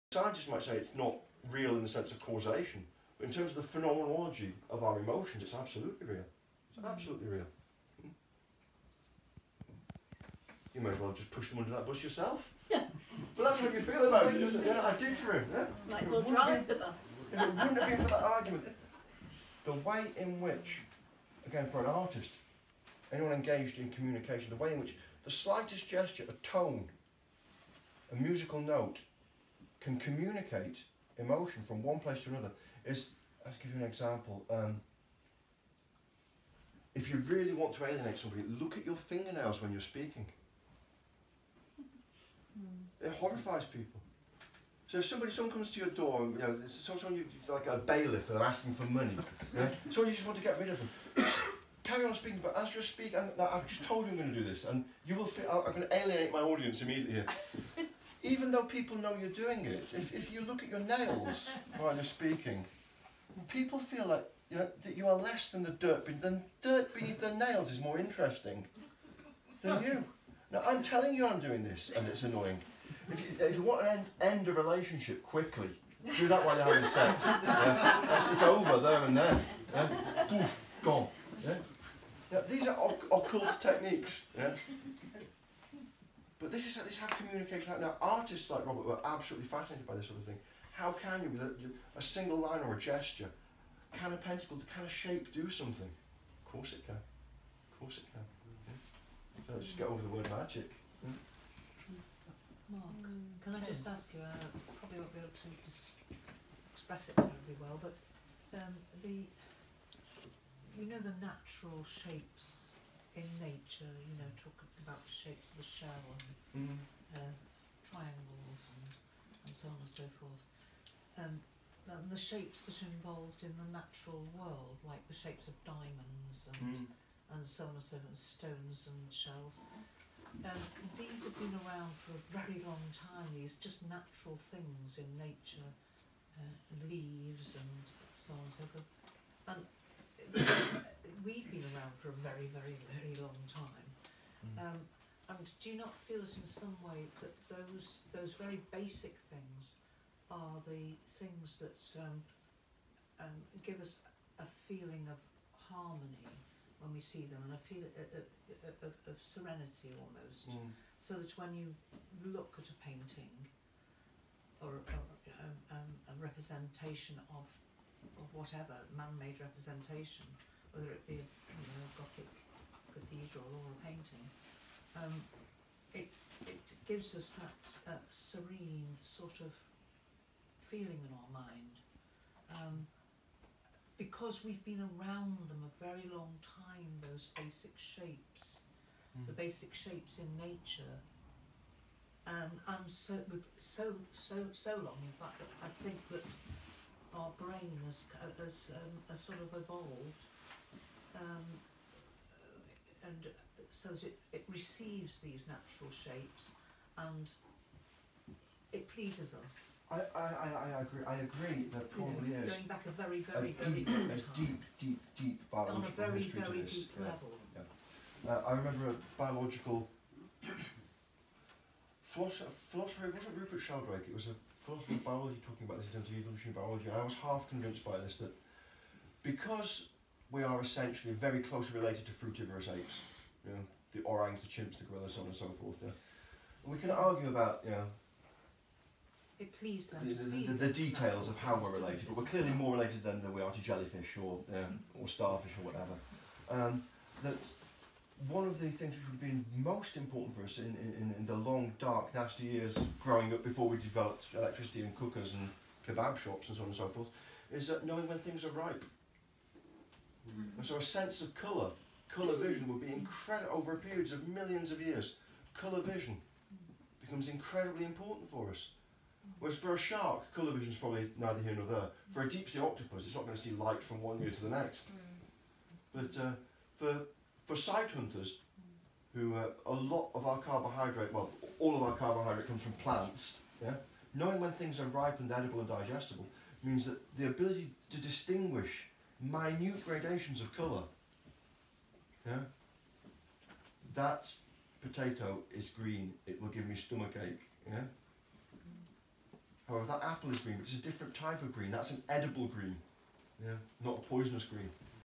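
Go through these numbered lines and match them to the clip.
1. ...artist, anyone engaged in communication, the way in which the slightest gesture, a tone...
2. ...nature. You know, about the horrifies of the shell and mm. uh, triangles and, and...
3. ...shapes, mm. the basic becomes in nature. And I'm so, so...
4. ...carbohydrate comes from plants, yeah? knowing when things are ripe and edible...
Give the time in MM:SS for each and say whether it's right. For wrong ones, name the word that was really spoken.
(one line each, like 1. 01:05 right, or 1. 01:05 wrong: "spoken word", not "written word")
1. 00:21 right
2. 01:53 wrong: "shapes", not "horrifies"
3. 03:07 wrong: "shapes", not "becomes"
4. 04:41 right.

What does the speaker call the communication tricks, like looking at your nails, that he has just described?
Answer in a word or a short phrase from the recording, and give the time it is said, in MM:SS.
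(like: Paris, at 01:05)
Occult techniques, at 01:23.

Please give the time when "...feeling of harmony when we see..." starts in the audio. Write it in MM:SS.
02:34.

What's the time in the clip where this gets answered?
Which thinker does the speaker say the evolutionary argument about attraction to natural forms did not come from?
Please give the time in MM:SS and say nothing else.
03:43.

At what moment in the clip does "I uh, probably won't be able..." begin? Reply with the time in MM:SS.
01:44.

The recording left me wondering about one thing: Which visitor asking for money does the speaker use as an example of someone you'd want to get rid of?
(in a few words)
A bailiff.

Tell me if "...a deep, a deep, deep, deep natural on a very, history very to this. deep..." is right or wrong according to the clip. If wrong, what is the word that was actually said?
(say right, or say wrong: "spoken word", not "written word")
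wrong: "biological", not "natural".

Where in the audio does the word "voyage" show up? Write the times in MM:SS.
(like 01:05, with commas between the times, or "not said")
not said.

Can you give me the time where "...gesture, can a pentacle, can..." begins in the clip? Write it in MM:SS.
01:32.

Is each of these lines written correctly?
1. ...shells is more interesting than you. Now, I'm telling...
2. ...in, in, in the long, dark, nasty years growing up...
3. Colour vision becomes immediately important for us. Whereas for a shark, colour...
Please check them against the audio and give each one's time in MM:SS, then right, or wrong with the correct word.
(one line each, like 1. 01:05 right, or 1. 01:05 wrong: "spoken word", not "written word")
1. 01:07 wrong: "nails", not "shells"
2. 04:10 right
3. 04:25 wrong: "incredibly", not "immediately".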